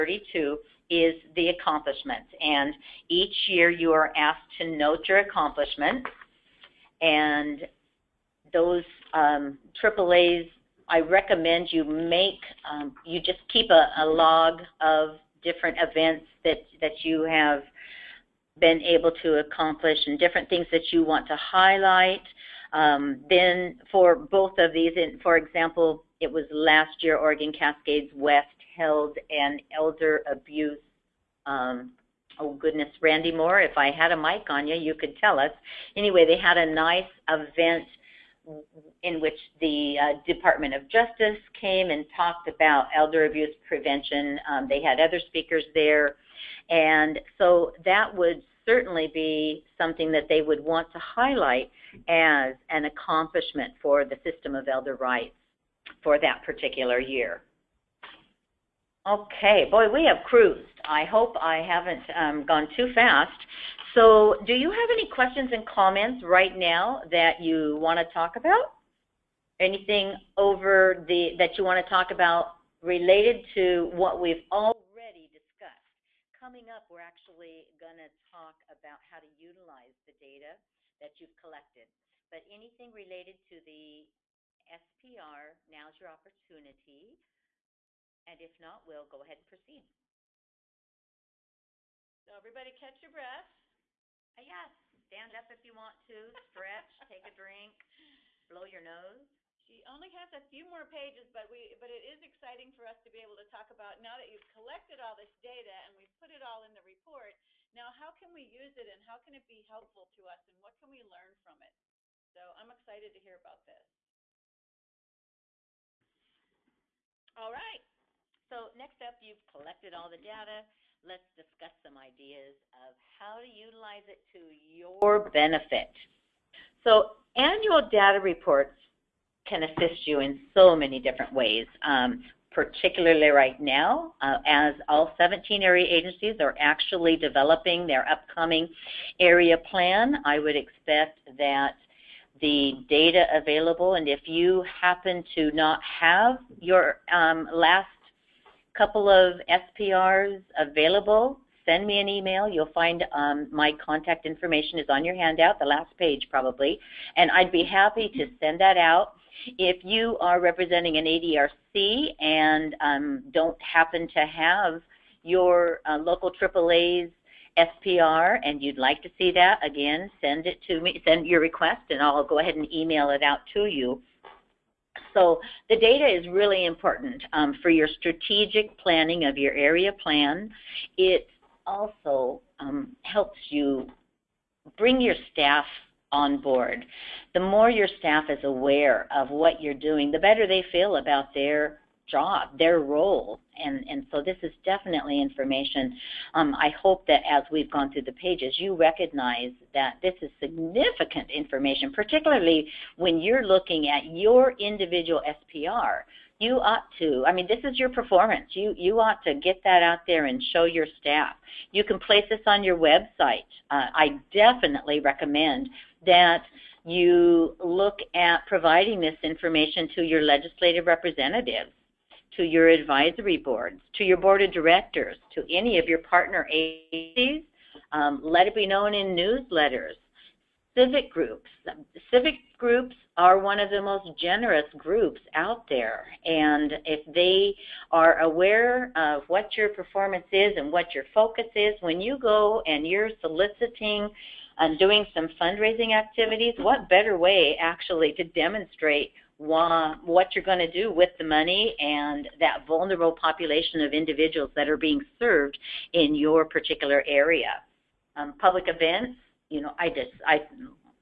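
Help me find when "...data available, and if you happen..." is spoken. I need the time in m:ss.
2:22.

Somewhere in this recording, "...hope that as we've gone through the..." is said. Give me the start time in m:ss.
3:16.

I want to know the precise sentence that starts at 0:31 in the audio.
Um, oh goodness, Randy Moore, if I had a mic on you, you could tell us.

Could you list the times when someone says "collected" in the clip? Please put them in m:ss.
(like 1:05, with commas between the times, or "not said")
1:21, 1:44, 1:59.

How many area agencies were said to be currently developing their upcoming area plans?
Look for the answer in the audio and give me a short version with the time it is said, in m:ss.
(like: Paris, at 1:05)
17, at 2:15.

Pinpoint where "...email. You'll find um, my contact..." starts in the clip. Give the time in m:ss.
2:32.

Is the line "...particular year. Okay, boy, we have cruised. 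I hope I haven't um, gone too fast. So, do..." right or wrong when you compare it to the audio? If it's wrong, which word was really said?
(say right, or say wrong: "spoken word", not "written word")
right.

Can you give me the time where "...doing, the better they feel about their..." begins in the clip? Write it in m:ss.
3:09.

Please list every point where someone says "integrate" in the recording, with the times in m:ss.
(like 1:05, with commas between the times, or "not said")
not said.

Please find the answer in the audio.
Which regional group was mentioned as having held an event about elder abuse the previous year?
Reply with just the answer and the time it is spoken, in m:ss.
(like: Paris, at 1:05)
Oregon Cascades West, at 0:27.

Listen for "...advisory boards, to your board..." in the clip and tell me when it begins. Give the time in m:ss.
3:42.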